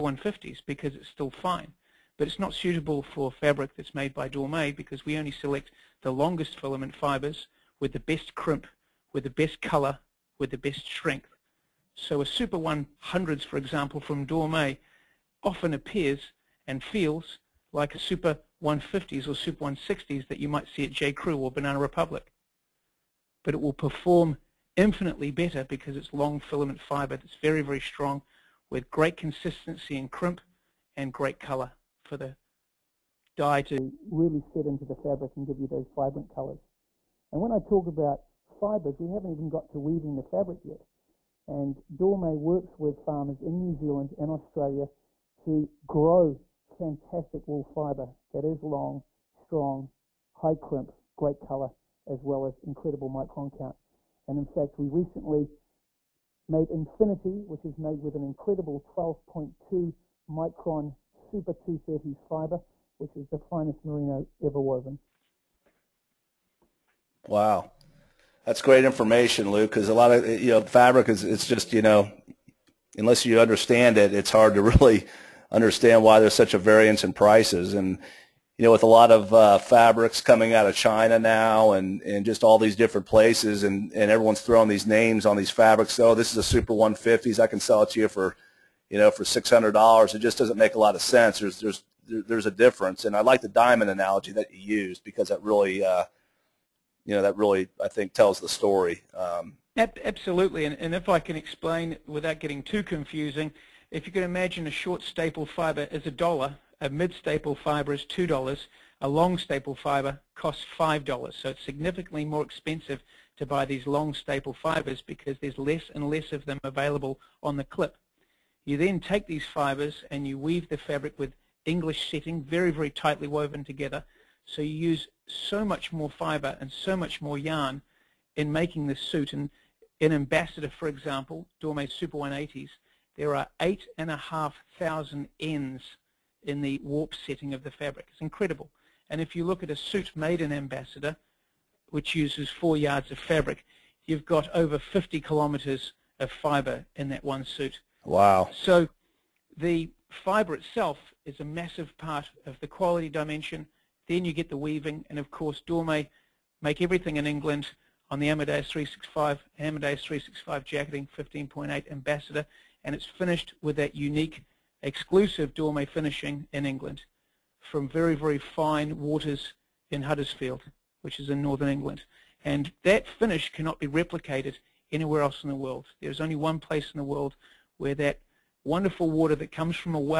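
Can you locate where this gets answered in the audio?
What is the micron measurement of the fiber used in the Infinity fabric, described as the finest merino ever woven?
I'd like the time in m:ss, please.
0:58.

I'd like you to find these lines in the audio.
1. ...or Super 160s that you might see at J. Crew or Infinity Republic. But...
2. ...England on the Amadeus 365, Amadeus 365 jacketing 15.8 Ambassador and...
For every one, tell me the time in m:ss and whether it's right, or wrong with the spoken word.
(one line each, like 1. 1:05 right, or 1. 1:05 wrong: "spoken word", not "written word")
1. 0:19 wrong: "Banana", not "Infinity"
2. 2:37 right.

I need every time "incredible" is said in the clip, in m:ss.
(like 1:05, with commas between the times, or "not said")
0:52, 0:58, 2:18.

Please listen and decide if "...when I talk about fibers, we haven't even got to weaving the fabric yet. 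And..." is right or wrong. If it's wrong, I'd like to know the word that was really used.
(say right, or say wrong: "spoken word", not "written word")
right.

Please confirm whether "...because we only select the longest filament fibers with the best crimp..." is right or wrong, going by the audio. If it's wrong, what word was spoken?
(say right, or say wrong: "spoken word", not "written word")
right.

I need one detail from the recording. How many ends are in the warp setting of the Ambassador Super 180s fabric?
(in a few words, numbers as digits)
8,500.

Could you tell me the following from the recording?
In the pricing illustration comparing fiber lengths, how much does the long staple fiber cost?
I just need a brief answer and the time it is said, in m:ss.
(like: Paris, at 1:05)
$5, at 1:50.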